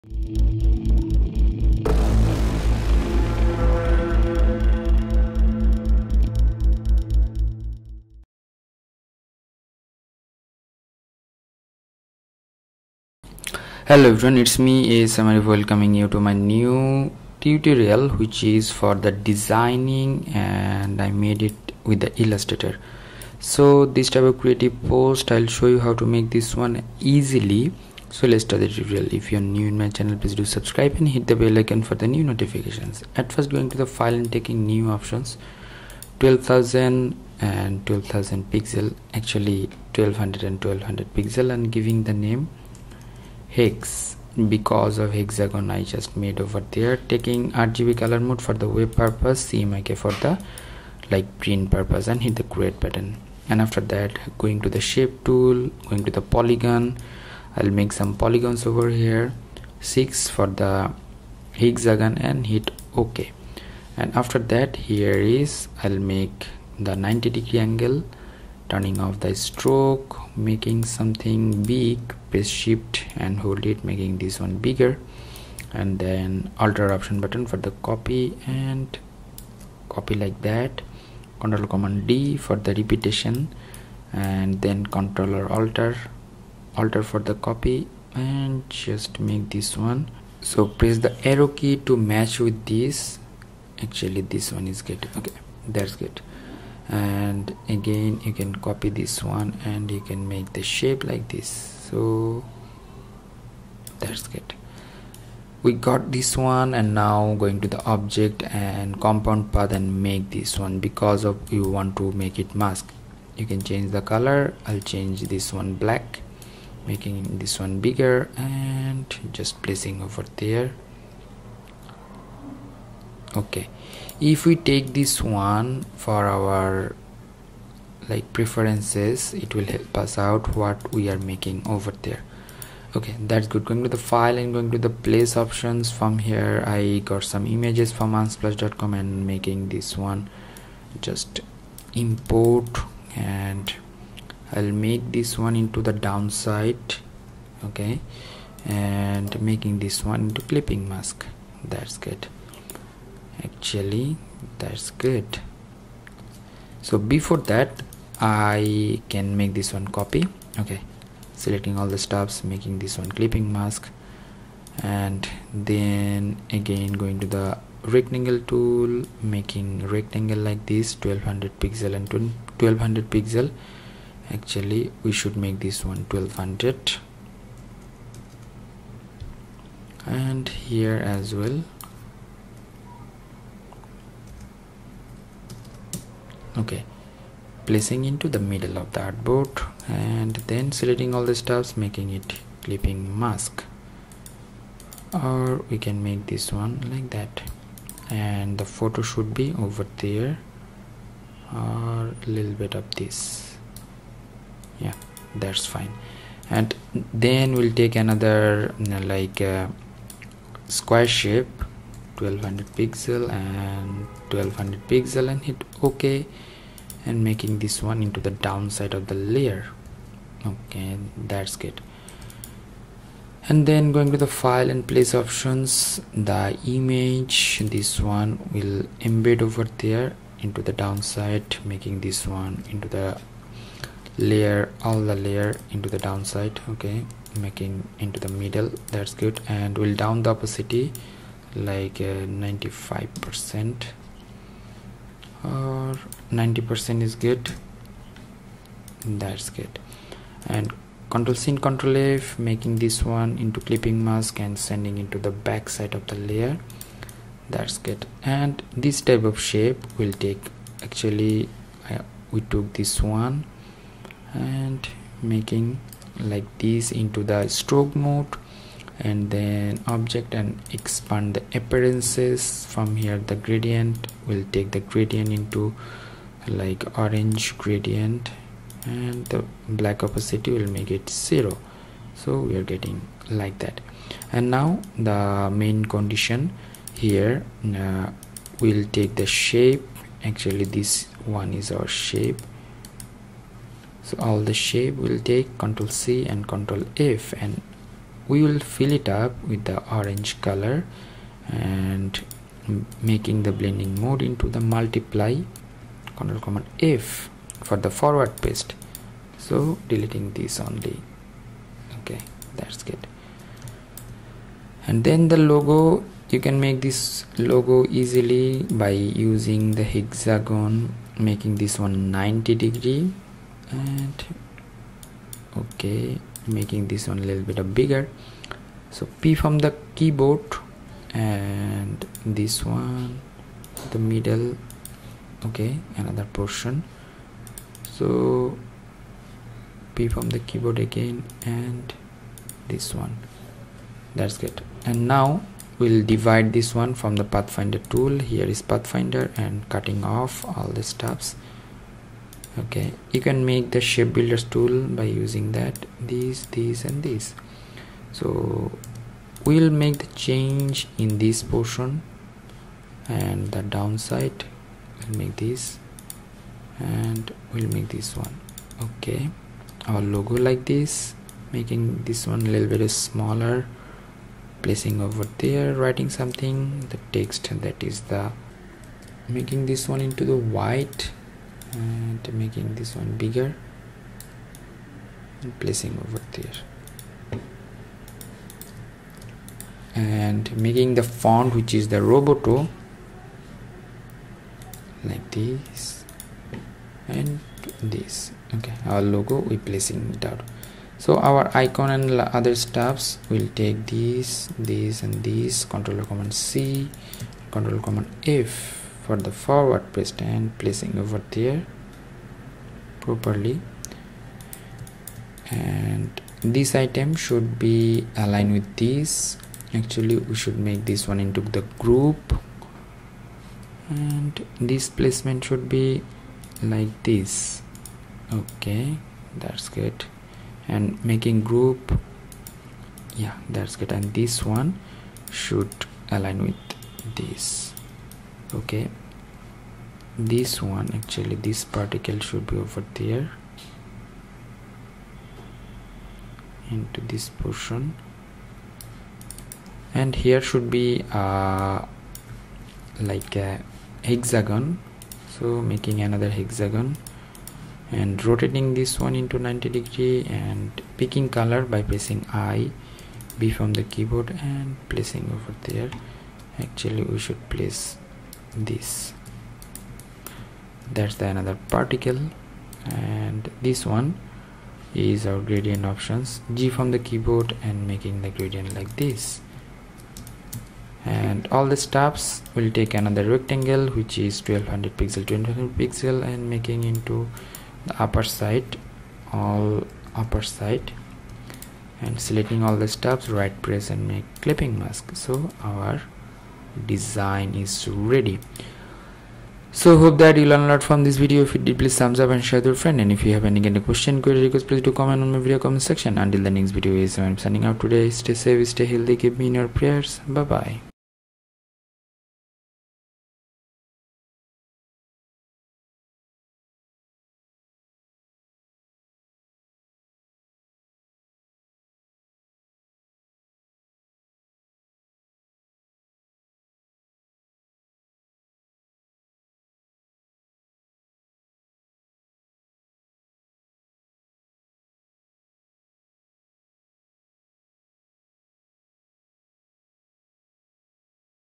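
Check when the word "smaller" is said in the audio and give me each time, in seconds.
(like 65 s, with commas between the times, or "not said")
372 s.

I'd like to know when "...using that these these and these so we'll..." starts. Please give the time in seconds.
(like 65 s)
355 s.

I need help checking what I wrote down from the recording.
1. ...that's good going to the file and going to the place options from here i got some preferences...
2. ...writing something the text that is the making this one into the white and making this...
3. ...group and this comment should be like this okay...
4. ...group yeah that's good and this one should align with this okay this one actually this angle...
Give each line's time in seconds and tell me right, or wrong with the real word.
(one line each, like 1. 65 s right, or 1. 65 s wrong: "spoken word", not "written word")
1. 133 s wrong: "images", not "preferences"
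2. 375 s right
3. 421 s wrong: "placement", not "comment"
4. 431 s wrong: "particle", not "angle".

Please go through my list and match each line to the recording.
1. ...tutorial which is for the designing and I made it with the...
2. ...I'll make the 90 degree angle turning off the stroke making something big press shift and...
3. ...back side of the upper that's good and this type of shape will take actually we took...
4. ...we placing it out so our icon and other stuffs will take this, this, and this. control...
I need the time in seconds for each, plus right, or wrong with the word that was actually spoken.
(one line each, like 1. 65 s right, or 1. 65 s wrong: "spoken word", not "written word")
1. 17 s right
2. 65 s right
3. 255 s wrong: "layer", not "upper"
4. 399 s right.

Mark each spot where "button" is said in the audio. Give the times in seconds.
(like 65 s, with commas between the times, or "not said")
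52 s, 77 s.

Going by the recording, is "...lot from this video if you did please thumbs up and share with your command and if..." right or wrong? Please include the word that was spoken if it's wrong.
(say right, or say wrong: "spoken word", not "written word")
wrong: "friend", not "command".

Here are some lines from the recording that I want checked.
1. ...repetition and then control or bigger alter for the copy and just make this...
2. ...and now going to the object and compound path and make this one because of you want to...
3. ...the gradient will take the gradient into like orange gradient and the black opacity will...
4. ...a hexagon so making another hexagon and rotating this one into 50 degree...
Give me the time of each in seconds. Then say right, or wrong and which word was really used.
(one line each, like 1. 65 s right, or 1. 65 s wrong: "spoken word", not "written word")
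1. 82 s wrong: "alter", not "bigger"
2. 106 s right
3. 273 s right
4. 453 s wrong: "90", not "50".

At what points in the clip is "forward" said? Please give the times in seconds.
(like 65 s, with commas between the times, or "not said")
307 s, 409 s.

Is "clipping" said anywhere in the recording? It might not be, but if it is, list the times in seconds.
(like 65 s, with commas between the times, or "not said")
150 s, 163 s, 192 s, 253 s, 494 s.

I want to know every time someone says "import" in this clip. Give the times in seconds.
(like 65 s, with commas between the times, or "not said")
141 s.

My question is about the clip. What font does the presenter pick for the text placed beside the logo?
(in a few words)
Roboto.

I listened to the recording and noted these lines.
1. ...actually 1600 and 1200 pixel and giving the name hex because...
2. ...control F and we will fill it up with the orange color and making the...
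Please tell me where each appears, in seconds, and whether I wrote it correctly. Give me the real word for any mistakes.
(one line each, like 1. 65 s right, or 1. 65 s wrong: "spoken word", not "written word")
1. 39 s wrong: "1200", not "1600"
2. 296 s right.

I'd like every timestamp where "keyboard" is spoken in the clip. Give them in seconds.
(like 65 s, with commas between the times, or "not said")
329 s, 340 s, 463 s, 476 s.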